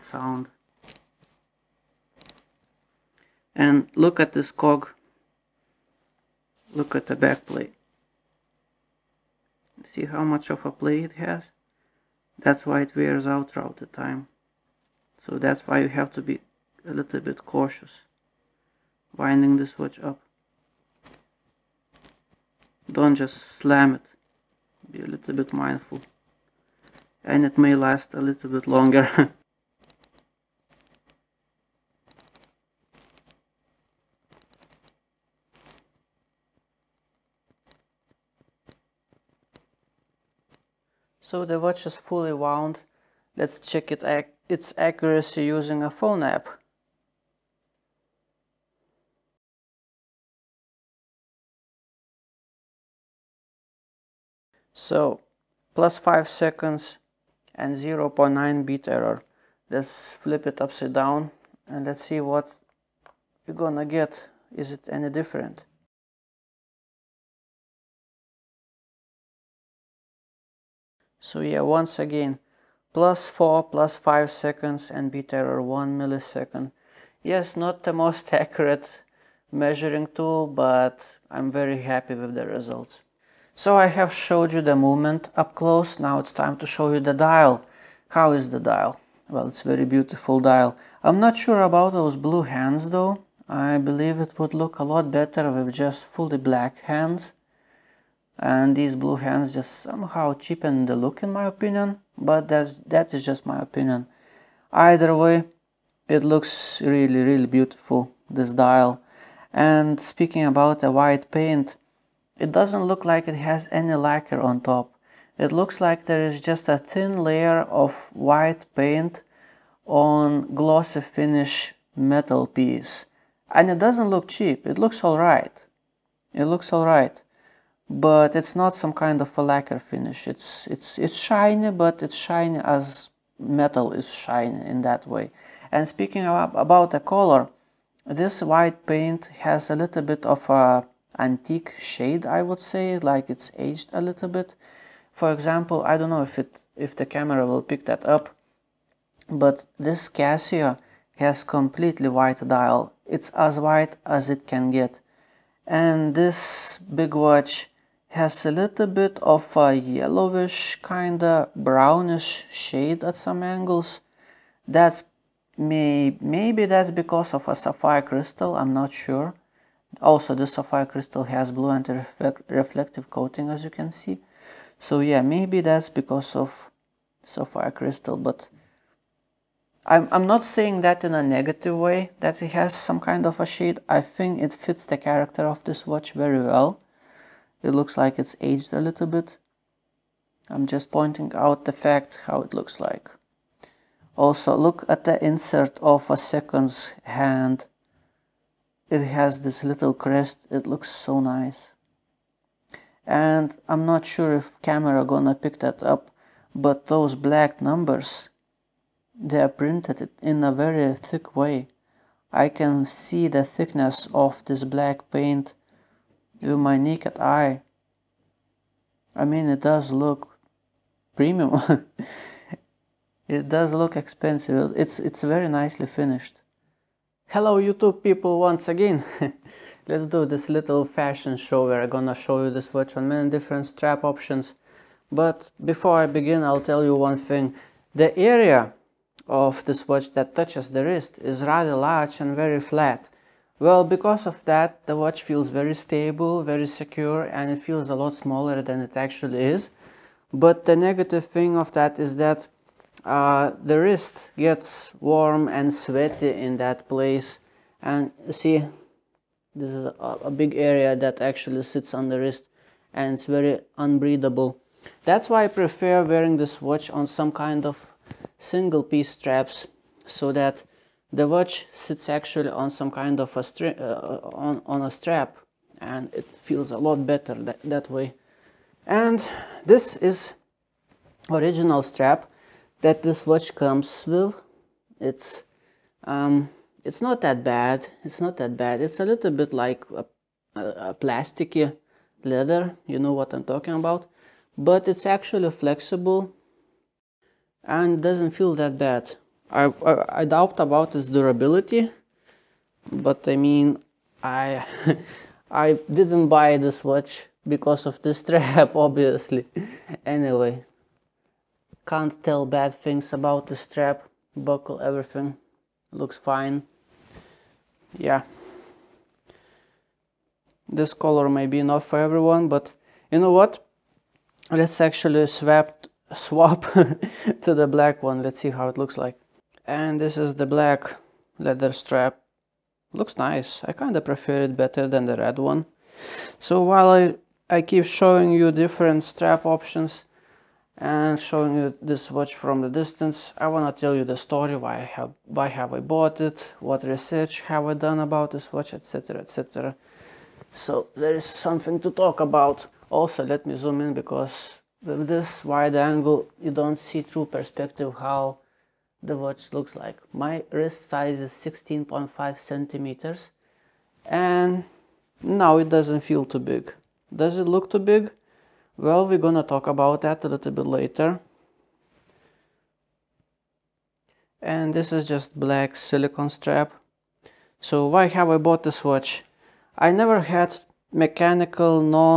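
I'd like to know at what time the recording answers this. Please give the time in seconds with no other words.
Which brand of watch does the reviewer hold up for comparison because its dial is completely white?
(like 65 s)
150 s.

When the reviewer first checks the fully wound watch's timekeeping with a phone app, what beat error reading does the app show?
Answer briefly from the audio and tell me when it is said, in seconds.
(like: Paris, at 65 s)
0.9, at 57 s.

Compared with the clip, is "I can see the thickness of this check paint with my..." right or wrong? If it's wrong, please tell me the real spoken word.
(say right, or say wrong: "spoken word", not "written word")
wrong: "black", not "check".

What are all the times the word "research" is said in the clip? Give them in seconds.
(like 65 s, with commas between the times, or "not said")
346 s.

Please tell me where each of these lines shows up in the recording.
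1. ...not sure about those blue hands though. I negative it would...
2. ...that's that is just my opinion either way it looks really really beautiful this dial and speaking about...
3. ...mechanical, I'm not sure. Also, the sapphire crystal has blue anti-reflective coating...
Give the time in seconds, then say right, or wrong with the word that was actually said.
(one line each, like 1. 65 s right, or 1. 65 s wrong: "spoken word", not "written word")
1. 91 s wrong: "believe", not "negative"
2. 102 s right
3. 168 s wrong: "crystal", not "mechanical".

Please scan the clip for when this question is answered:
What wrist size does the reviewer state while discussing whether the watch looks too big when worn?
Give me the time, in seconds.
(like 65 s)
361 s.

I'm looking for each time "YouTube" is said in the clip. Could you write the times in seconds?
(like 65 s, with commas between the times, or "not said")
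227 s.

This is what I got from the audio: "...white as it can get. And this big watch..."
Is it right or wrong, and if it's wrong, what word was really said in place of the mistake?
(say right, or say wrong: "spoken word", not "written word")
right.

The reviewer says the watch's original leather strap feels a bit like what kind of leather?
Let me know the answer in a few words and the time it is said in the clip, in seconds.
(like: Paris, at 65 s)
Plasticky leather, at 290 s.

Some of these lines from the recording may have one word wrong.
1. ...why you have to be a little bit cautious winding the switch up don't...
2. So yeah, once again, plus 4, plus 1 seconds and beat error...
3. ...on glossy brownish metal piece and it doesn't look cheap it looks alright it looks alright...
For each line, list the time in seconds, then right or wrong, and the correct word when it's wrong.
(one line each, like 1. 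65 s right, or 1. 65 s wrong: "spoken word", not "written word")
1. 15 s right
2. 71 s wrong: "5", not "1"
3. 119 s wrong: "finish", not "brownish".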